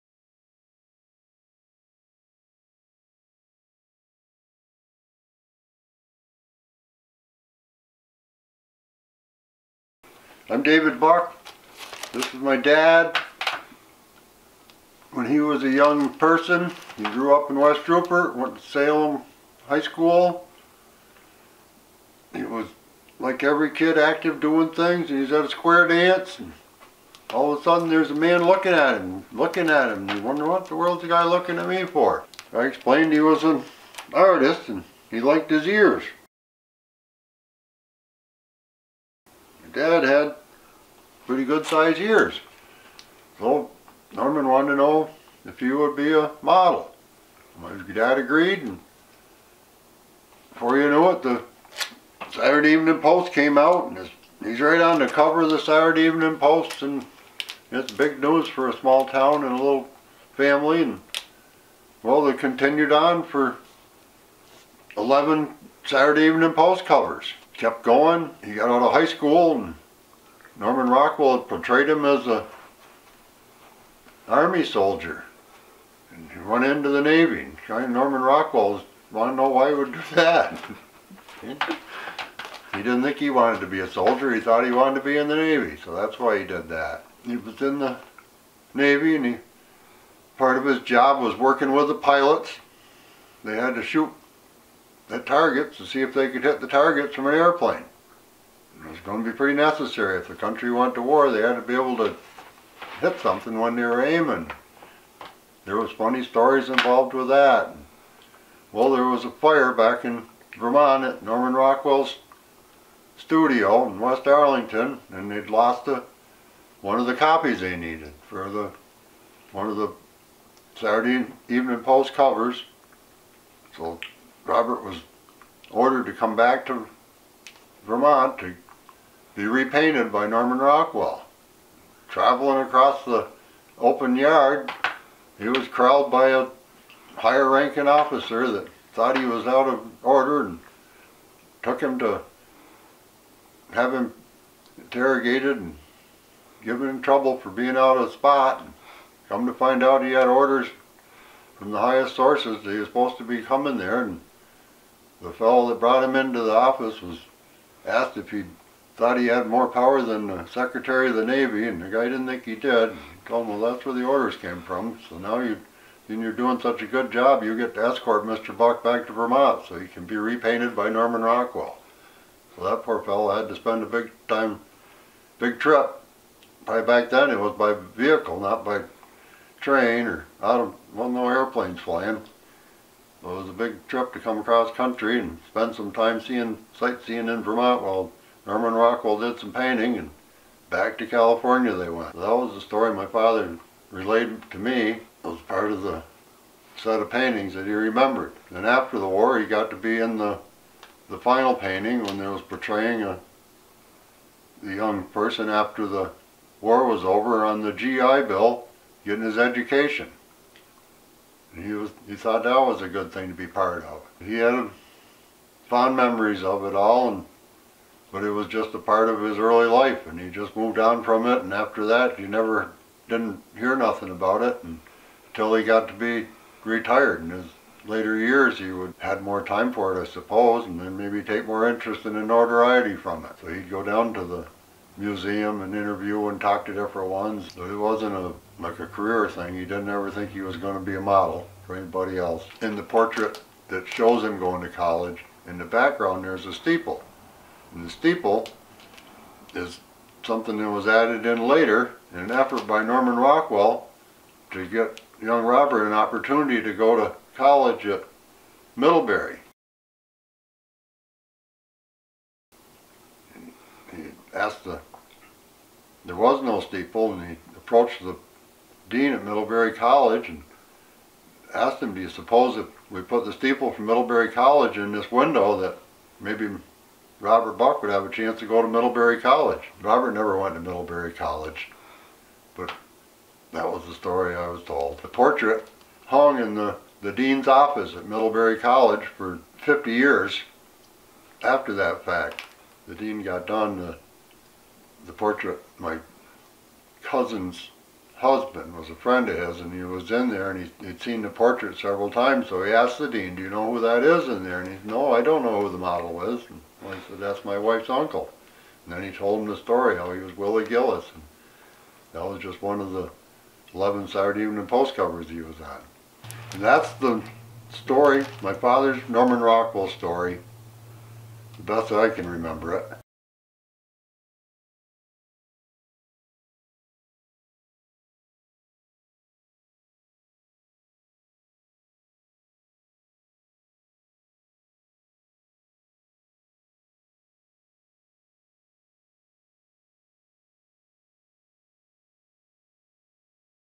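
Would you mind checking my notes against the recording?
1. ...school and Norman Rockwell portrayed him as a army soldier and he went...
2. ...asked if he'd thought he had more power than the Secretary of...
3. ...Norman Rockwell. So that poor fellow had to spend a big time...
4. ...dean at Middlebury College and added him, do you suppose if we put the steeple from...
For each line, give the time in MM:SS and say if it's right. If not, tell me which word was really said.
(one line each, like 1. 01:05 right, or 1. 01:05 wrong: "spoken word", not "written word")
1. 01:09 right
2. 02:37 right
3. 02:50 right
4. 04:28 wrong: "asked", not "added".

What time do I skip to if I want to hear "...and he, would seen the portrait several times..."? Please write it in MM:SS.
05:00.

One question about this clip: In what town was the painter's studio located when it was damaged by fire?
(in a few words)
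West Arlington.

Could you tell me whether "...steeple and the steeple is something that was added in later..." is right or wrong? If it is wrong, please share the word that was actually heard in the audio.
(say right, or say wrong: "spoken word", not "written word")
right.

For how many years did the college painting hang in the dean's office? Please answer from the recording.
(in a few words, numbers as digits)
50.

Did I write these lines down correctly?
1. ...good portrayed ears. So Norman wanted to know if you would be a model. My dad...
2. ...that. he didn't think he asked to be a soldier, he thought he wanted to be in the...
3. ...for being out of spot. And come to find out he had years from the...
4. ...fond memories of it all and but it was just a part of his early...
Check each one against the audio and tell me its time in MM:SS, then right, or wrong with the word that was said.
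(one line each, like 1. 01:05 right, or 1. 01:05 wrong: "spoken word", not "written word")
1. 00:41 wrong: "sized", not "portrayed"
2. 01:20 wrong: "wanted", not "asked"
3. 02:27 wrong: "orders", not "years"
4. 03:35 right.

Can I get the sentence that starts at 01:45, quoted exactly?
There was funny stories involved with that.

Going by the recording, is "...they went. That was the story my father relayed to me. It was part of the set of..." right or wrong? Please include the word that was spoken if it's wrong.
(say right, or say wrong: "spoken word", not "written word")
right.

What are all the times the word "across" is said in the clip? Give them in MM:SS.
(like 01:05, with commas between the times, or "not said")
02:12, 03:04.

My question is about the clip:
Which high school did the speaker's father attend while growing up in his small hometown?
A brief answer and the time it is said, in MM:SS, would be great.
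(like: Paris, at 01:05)
Salem High School, at 00:18.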